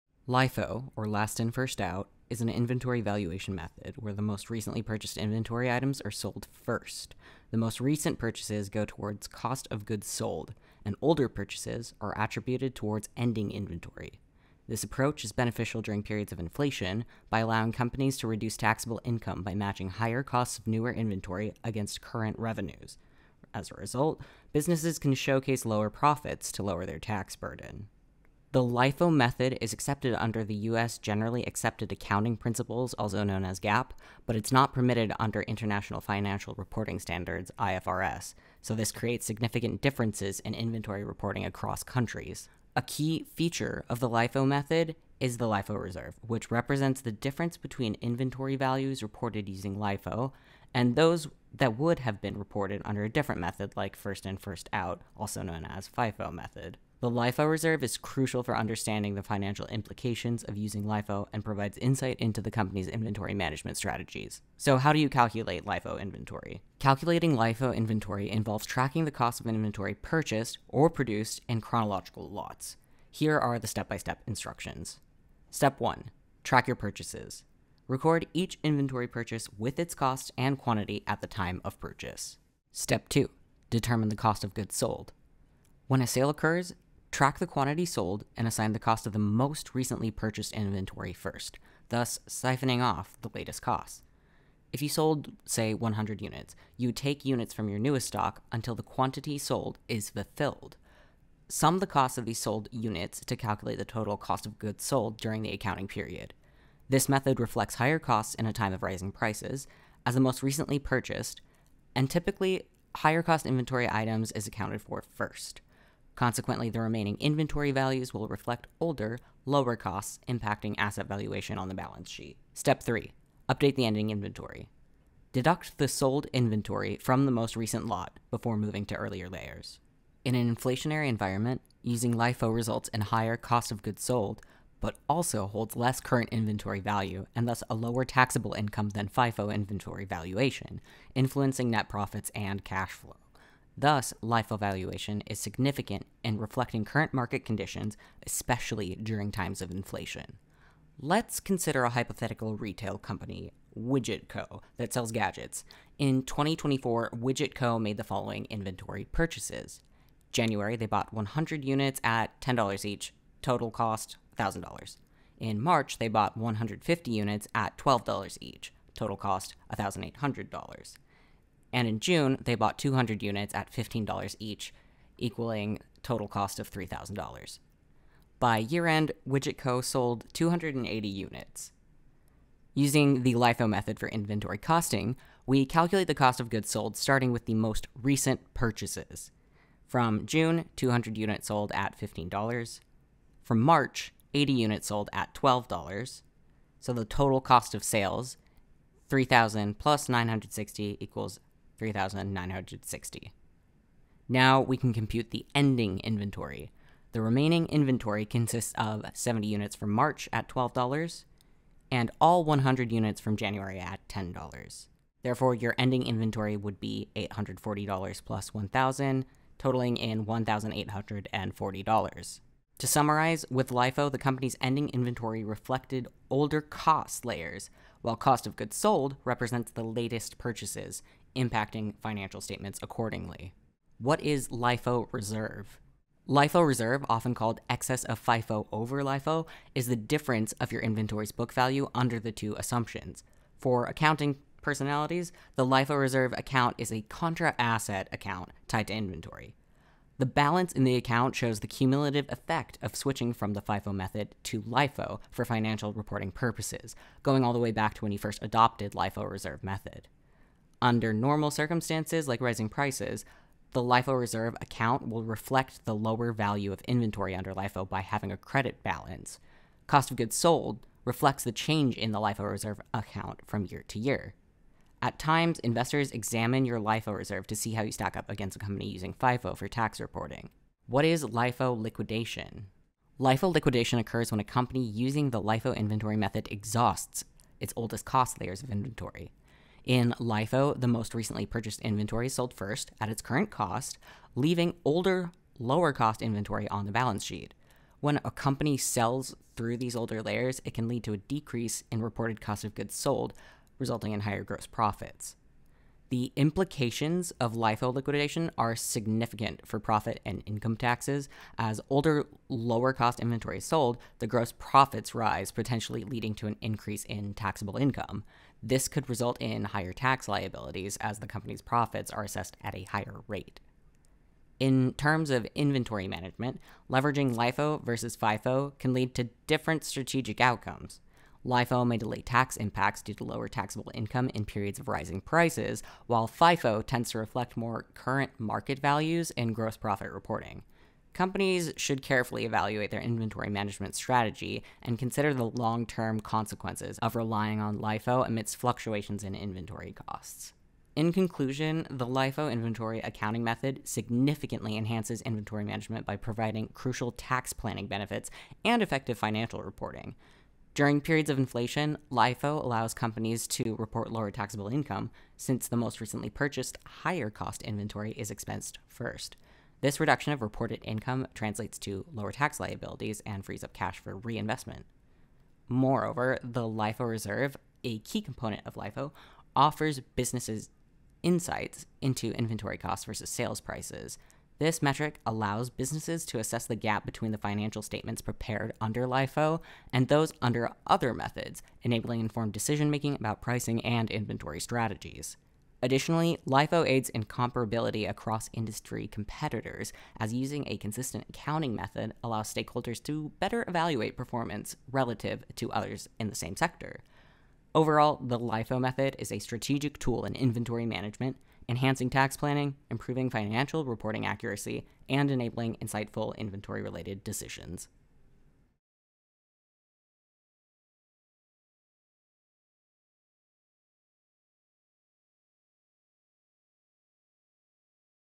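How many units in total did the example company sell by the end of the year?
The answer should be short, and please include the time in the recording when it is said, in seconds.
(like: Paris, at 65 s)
280, at 180 s.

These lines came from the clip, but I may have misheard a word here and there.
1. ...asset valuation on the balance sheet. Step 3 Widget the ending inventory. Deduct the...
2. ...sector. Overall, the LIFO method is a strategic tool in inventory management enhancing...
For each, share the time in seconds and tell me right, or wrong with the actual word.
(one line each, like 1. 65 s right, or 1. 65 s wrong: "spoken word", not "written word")
1. 120 s wrong: "Update", not "Widget"
2. 406 s right.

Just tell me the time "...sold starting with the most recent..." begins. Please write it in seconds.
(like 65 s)
186 s.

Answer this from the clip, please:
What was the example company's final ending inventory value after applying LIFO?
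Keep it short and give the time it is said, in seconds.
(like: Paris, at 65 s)
$1,840, at 220 s.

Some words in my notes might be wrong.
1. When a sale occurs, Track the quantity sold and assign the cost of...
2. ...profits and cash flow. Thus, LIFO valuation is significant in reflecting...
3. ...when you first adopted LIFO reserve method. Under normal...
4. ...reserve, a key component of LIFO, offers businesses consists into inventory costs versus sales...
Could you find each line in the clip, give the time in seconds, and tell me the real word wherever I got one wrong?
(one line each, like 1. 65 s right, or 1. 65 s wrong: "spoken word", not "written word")
1. 85 s right
2. 141 s right
3. 258 s right
4. 377 s wrong: "insights", not "consists".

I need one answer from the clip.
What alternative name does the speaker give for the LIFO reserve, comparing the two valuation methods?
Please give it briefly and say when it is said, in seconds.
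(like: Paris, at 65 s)
excess of FIFO over LIFO, at 237 s.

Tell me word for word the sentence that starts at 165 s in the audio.
In March, they bought 150 units at $12 each, total cost $1,800.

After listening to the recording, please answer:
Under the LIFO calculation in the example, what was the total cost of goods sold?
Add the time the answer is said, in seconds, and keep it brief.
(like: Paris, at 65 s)
3,960, at 201 s.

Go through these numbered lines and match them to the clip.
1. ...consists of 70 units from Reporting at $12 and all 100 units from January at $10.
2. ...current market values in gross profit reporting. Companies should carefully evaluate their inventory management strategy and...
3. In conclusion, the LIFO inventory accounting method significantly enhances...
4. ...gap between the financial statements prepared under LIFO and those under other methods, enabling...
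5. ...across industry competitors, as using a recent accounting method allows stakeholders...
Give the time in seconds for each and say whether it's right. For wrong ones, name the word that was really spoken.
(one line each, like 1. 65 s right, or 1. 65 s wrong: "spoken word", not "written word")
1. 208 s wrong: "March", not "Reporting"
2. 337 s right
3. 350 s right
4. 386 s right
5. 398 s wrong: "consistent", not "recent".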